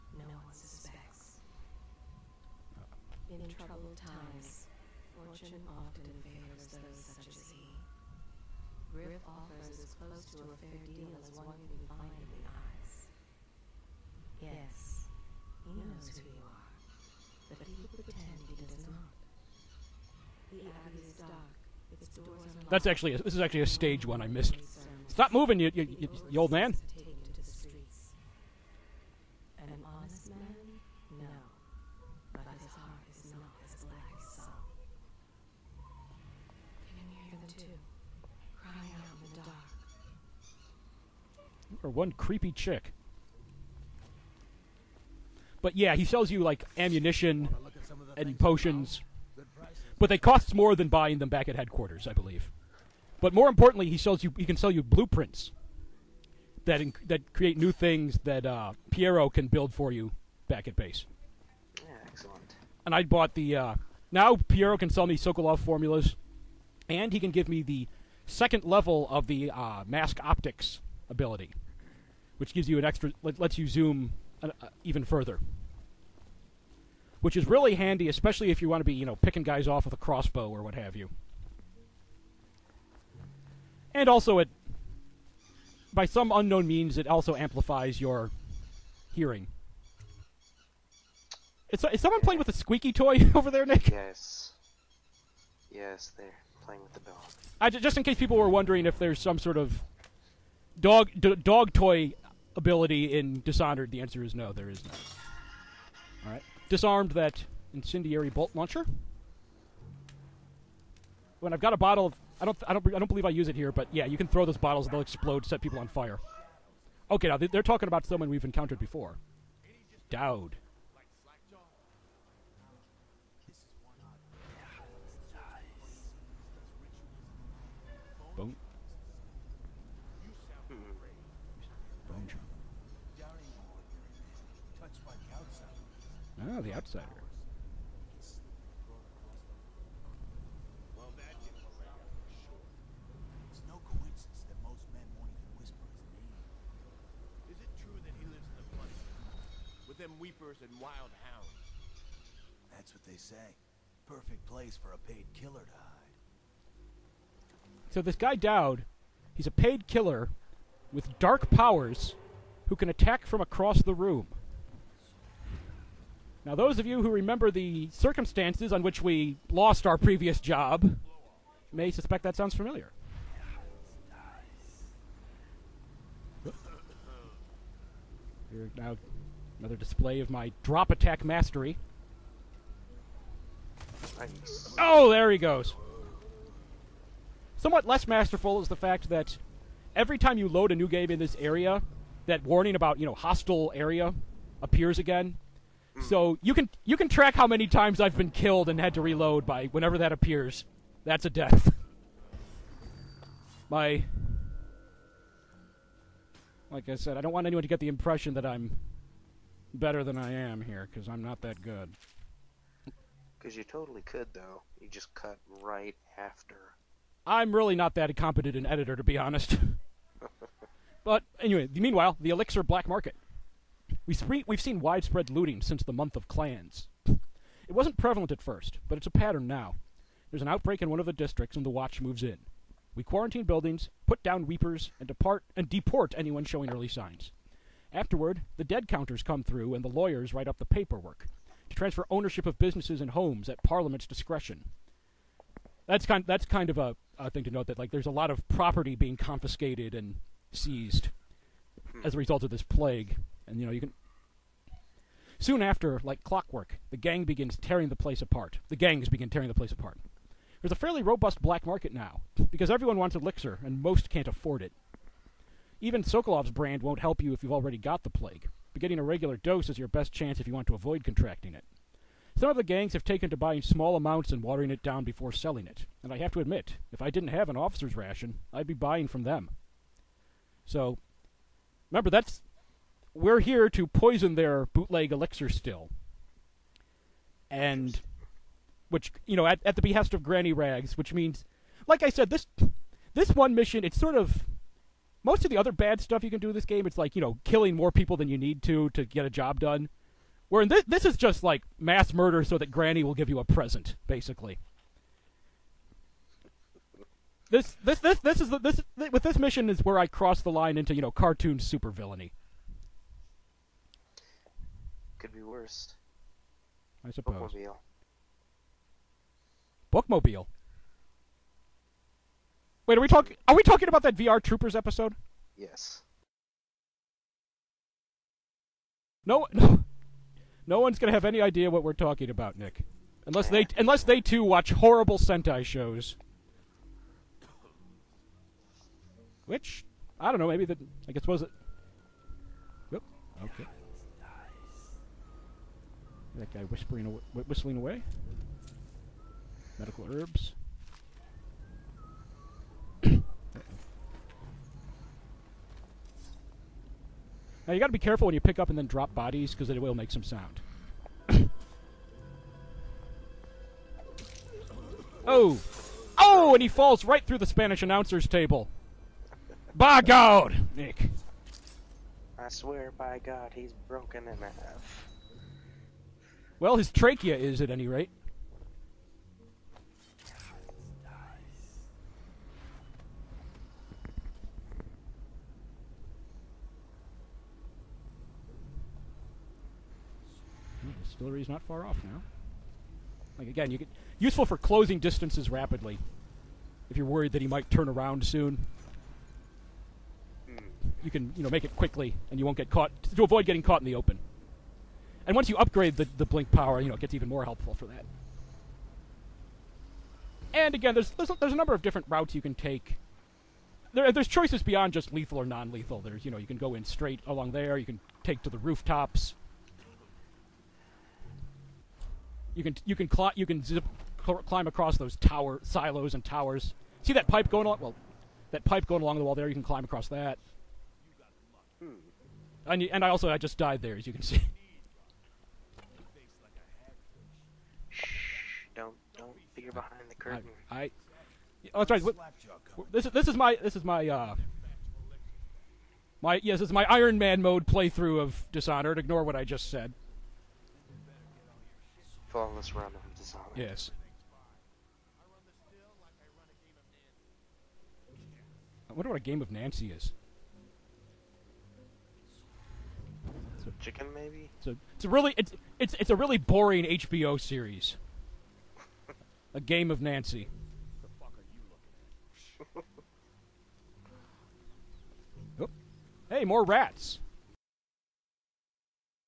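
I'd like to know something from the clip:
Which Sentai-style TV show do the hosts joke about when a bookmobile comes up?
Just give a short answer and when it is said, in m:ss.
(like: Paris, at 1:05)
VR Troopers, at 5:24.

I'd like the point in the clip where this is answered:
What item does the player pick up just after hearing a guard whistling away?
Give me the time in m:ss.
5:49.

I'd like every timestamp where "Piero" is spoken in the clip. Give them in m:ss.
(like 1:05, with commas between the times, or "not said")
0:58, 1:04.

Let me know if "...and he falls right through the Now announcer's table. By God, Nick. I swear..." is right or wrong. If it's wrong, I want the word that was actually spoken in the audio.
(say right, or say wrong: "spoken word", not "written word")
wrong: "Spanish", not "Now".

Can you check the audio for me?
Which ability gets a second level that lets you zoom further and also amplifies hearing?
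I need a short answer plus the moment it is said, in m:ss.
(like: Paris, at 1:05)
mask optics, at 1:09.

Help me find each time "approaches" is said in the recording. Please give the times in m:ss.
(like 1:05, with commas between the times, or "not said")
not said.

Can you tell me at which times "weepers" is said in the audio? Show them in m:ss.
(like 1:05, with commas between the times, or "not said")
2:30, 3:54.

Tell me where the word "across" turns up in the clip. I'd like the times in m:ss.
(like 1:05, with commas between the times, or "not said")
2:43, 7:04, 7:09.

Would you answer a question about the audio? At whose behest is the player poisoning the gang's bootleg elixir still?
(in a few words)
Granny Rags.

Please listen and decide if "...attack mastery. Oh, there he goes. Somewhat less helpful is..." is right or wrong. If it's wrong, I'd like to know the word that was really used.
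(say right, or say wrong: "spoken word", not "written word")
wrong: "masterful", not "helpful".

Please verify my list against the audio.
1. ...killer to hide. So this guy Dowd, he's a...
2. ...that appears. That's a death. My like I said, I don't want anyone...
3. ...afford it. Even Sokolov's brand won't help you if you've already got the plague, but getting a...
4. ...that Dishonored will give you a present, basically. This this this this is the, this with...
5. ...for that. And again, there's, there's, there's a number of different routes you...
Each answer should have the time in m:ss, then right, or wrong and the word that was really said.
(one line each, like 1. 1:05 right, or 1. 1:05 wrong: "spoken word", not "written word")
1. 2:35 right
2. 3:19 right
3. 4:24 right
4. 5:02 wrong: "Granny", not "Dishonored"
5. 6:47 right.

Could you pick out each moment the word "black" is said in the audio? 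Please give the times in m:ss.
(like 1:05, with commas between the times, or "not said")
3:42, 4:21.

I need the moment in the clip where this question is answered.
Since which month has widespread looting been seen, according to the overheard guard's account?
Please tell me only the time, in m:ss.
3:45.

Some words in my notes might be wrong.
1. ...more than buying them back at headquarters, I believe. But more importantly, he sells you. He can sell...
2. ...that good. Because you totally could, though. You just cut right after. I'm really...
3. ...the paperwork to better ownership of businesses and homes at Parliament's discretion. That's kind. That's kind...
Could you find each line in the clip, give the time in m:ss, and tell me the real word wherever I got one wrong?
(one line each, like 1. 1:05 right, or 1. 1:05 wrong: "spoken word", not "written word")
1. 0:50 right
2. 3:31 right
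3. 4:00 wrong: "transfer", not "better".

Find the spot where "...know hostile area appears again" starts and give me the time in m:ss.
3:13.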